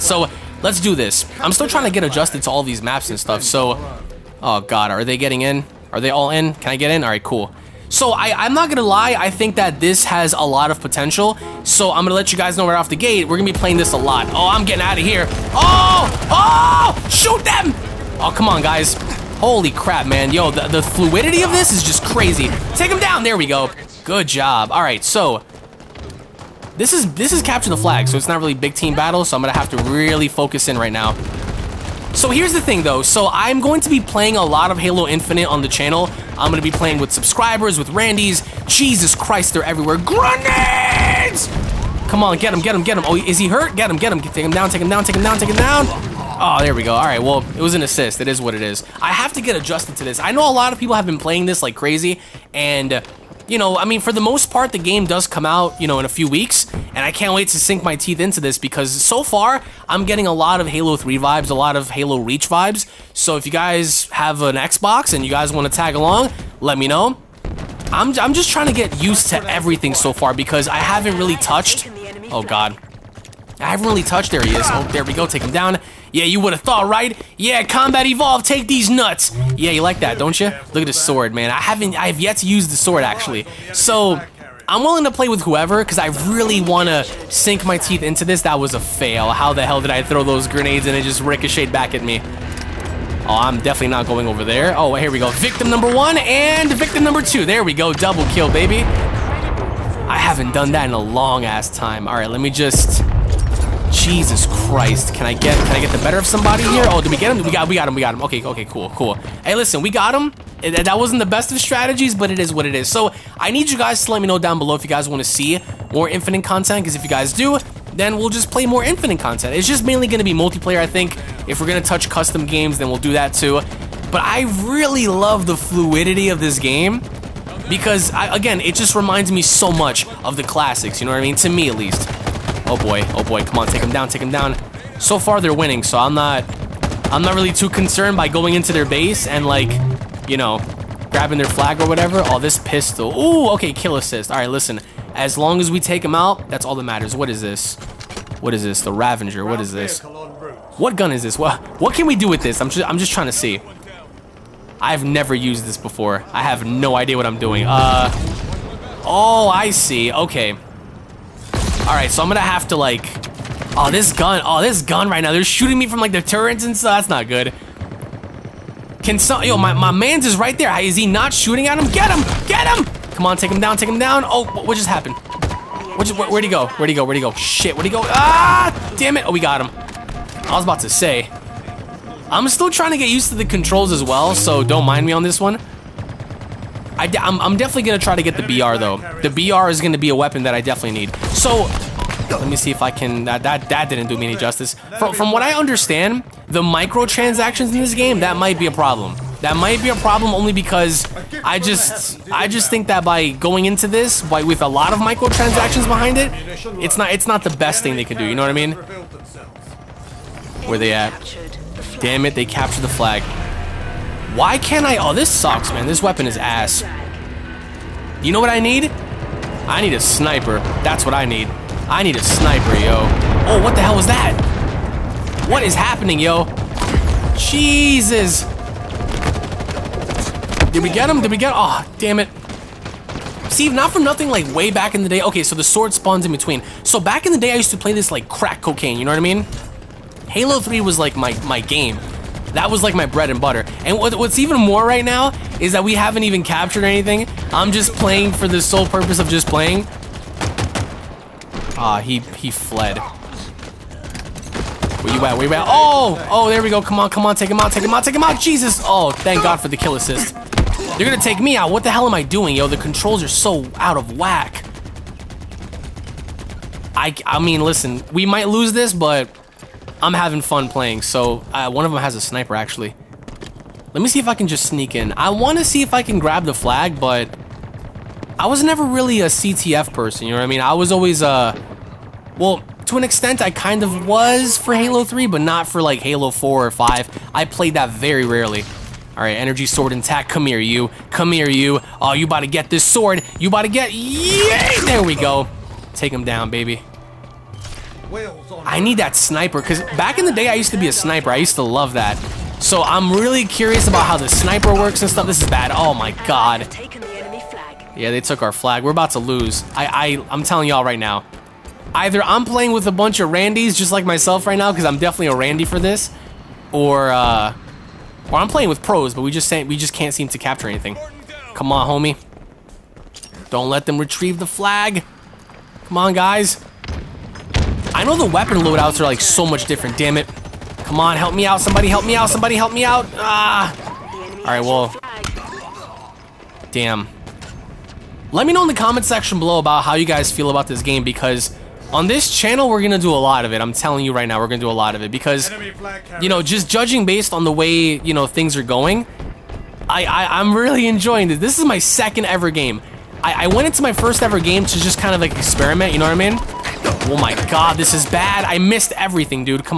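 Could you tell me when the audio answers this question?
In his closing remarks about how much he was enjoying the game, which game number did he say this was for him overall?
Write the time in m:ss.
5:51.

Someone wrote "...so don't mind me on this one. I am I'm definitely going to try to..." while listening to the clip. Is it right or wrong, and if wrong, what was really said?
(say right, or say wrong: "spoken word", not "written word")
right.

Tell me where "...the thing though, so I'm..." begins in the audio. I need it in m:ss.
0:32.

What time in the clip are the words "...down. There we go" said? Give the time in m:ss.
0:22.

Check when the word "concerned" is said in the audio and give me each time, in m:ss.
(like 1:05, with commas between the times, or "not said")
2:17.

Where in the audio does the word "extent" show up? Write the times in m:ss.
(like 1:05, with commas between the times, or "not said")
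4:43.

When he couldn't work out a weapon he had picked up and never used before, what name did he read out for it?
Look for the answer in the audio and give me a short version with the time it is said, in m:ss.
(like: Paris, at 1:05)
The Ravager, at 2:28.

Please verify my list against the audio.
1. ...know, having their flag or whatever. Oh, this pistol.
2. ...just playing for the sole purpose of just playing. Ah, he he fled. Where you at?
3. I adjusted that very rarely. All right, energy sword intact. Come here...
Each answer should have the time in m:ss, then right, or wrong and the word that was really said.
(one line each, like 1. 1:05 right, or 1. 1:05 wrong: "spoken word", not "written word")
1. 2:20 wrong: "grabbing", not "having"
2. 4:07 right
3. 4:47 wrong: "played", not "adjusted".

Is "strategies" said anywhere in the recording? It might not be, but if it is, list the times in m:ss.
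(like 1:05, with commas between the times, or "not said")
1:51.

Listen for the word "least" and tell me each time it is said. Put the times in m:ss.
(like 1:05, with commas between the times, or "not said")
2:11.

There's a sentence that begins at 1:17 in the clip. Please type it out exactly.
Yeah, Combat Evolve, take these nuts.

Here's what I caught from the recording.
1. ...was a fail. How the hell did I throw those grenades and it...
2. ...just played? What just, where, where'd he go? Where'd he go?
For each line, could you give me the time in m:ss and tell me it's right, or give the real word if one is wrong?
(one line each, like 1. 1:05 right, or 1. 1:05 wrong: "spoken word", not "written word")
1. 1:28 right
2. 2:54 wrong: "happened", not "played".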